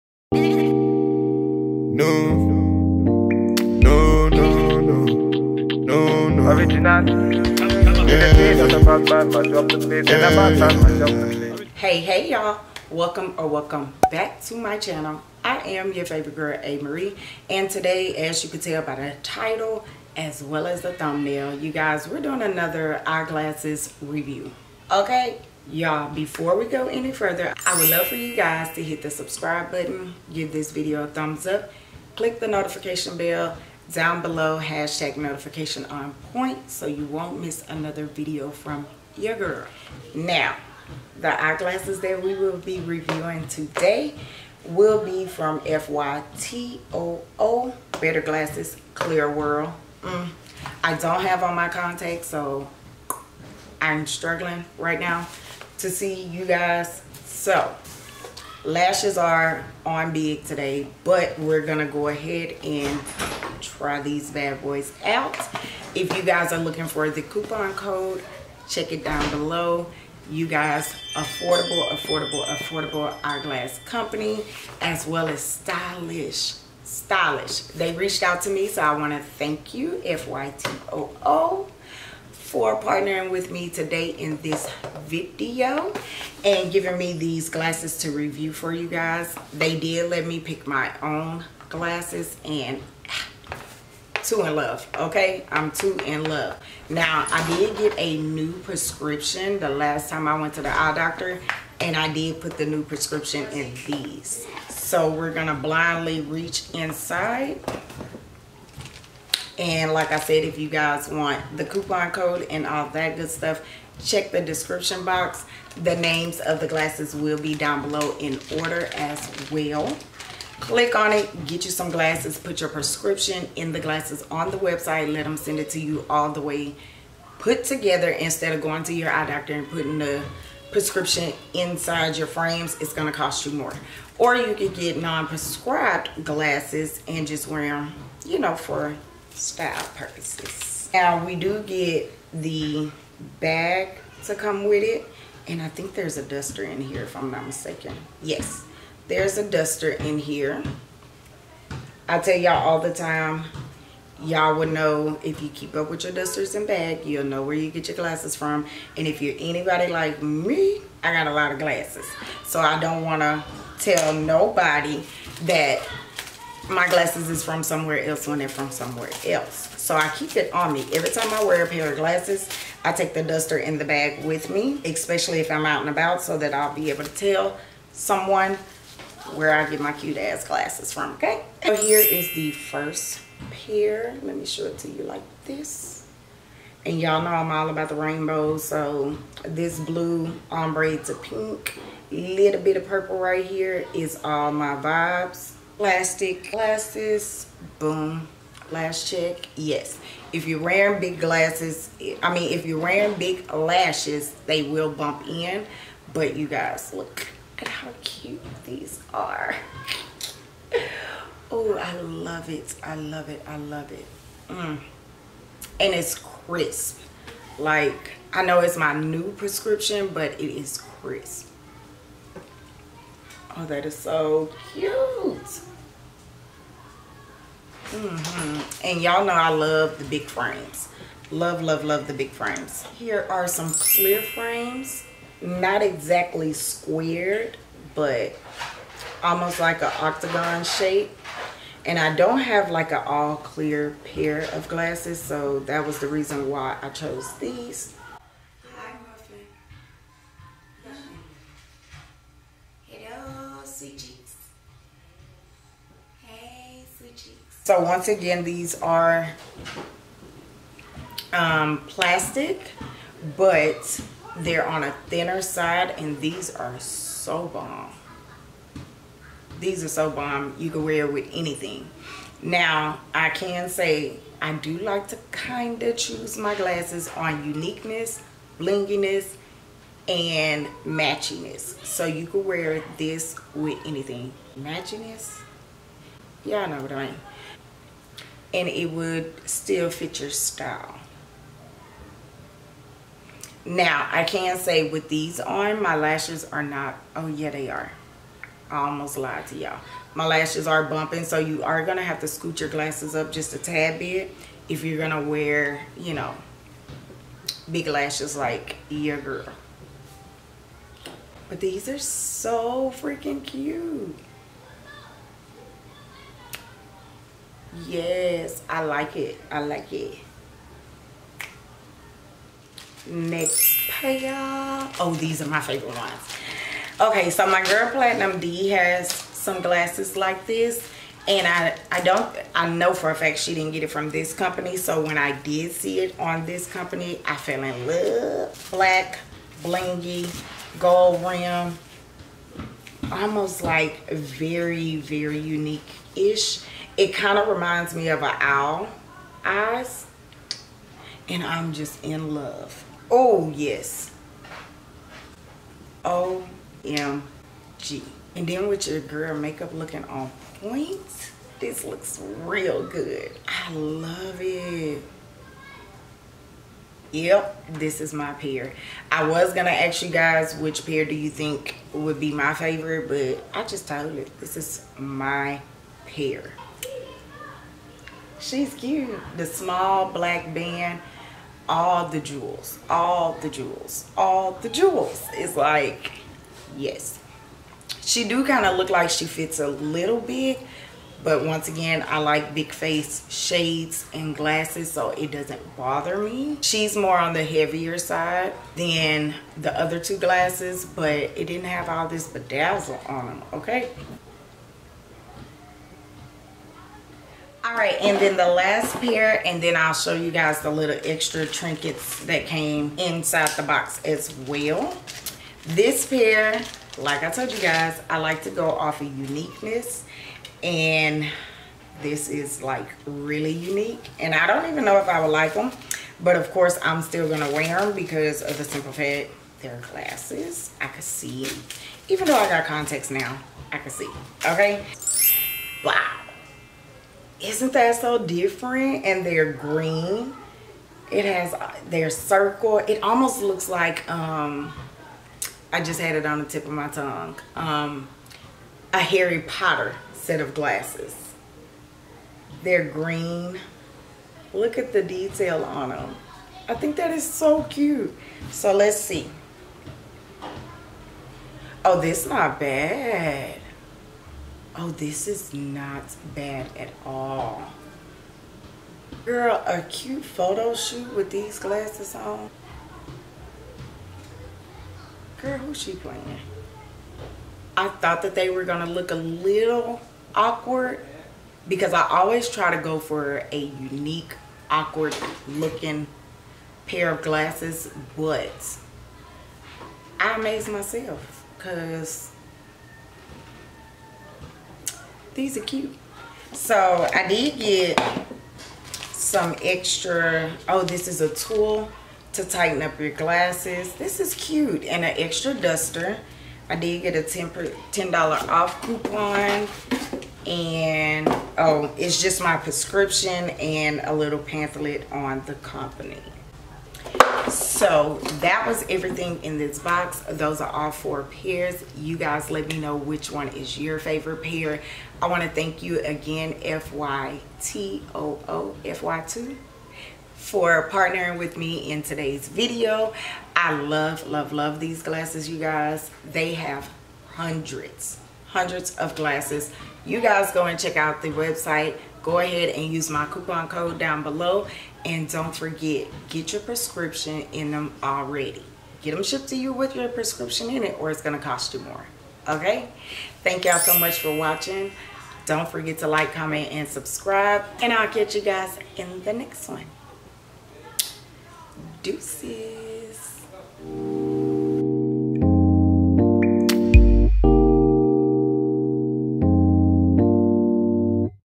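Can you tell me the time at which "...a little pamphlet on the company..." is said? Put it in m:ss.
8:34.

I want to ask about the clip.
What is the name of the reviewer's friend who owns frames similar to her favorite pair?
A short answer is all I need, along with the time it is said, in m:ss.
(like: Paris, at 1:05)
Platinum D, at 5:27.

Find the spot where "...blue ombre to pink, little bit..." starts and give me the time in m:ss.
3:09.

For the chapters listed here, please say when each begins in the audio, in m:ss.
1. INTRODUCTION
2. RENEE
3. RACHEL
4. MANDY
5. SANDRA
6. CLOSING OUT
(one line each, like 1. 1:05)
1. 0:11
2. 3:01
3. 3:53
4. 5:23
5. 6:48
6. 8:16.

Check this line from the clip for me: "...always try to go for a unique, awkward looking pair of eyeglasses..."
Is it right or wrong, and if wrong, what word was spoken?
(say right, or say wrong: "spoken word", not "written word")
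wrong: "glasses", not "eyeglasses".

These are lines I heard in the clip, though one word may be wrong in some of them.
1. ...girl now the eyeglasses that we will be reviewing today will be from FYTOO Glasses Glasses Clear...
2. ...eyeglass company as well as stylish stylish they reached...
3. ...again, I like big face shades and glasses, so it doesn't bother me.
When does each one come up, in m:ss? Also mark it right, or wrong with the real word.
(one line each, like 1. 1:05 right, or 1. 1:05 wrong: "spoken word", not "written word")
1. 0:39 wrong: "Better", not "Glasses"
2. 1:13 right
3. 6:31 right.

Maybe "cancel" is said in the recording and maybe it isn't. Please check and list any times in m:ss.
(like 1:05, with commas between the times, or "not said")
not said.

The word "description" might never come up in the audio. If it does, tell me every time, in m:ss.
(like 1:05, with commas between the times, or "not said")
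1:54.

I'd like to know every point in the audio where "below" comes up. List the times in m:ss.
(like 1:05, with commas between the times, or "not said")
0:34, 1:09, 1:57, 9:04.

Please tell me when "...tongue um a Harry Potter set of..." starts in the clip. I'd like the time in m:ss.
7:26.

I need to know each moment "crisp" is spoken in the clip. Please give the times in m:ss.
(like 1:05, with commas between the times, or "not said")
3:36, 3:41.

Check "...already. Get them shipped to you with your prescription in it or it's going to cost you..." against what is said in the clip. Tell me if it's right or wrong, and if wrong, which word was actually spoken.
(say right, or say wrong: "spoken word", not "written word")
right.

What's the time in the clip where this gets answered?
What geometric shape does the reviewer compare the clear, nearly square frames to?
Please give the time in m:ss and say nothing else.
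4:00.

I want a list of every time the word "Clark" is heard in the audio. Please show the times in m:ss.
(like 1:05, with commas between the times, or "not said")
not said.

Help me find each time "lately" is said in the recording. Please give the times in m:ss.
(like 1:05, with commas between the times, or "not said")
not said.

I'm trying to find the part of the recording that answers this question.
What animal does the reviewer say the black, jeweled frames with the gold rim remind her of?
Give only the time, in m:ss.
5:48.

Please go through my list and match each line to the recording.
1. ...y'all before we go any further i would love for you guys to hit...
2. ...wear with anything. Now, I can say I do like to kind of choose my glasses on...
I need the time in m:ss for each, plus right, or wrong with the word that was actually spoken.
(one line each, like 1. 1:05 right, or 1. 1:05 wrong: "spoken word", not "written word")
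1. 0:25 right
2. 4:30 right.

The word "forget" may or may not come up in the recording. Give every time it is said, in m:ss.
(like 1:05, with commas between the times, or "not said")
9:05, 9:15.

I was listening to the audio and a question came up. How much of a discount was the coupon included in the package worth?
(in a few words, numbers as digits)
$10 off.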